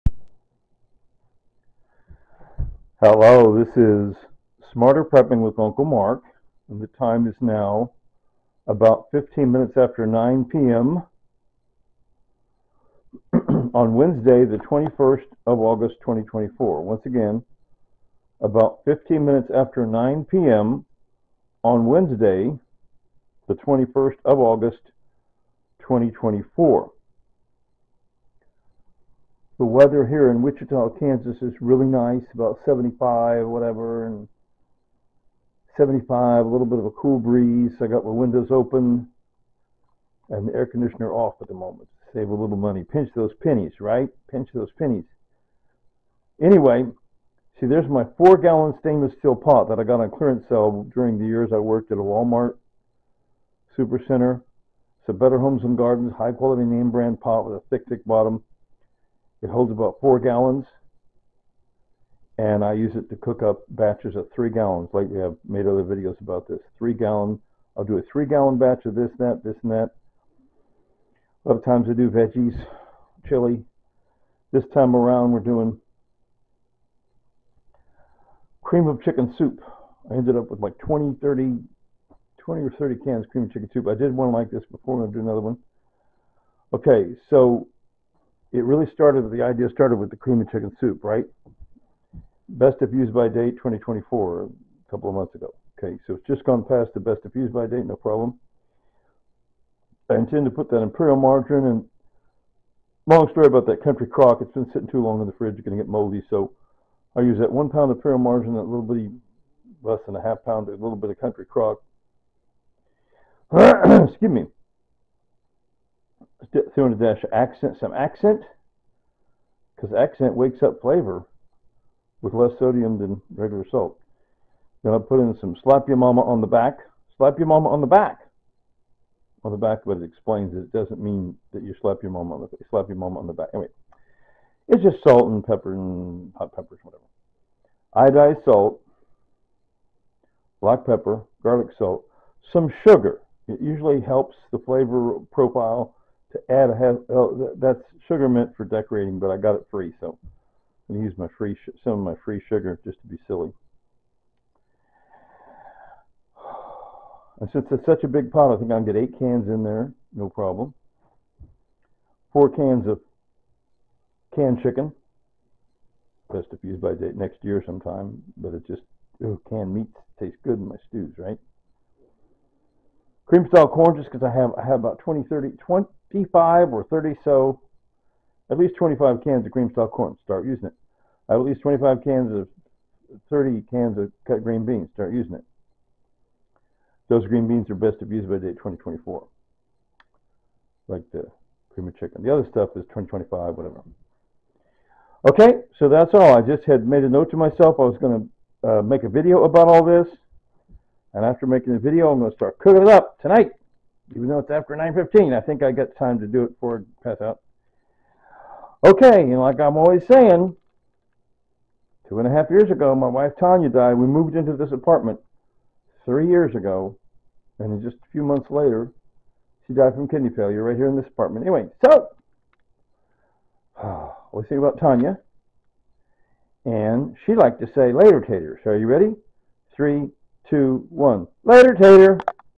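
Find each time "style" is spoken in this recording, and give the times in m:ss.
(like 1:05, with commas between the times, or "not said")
2:53, 2:59.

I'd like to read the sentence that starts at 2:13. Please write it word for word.
Anyway, it's just salt and pepper and hot peppers, whatever.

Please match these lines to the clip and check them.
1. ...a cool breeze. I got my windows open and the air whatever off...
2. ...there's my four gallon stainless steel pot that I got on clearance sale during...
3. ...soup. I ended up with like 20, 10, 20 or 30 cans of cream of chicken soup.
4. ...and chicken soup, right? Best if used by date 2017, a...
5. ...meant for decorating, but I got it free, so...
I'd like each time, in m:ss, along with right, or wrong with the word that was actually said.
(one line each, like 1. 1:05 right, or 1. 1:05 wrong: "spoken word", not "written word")
1. 0:36 wrong: "conditioner", not "whatever"
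2. 0:47 right
3. 1:19 wrong: "30", not "10"
4. 1:30 wrong: "2024", not "2017"
5. 2:28 right.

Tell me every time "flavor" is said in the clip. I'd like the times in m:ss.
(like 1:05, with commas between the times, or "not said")
2:00, 2:24.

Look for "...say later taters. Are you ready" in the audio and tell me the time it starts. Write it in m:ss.
3:47.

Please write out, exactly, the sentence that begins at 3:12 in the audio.
The other stuff is 2025, whatever.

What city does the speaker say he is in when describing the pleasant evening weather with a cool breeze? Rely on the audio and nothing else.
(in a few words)
Wichita, Kansas.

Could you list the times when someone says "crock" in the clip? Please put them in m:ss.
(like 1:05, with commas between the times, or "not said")
1:44, 1:51.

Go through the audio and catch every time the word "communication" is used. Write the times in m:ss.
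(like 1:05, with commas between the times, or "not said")
not said.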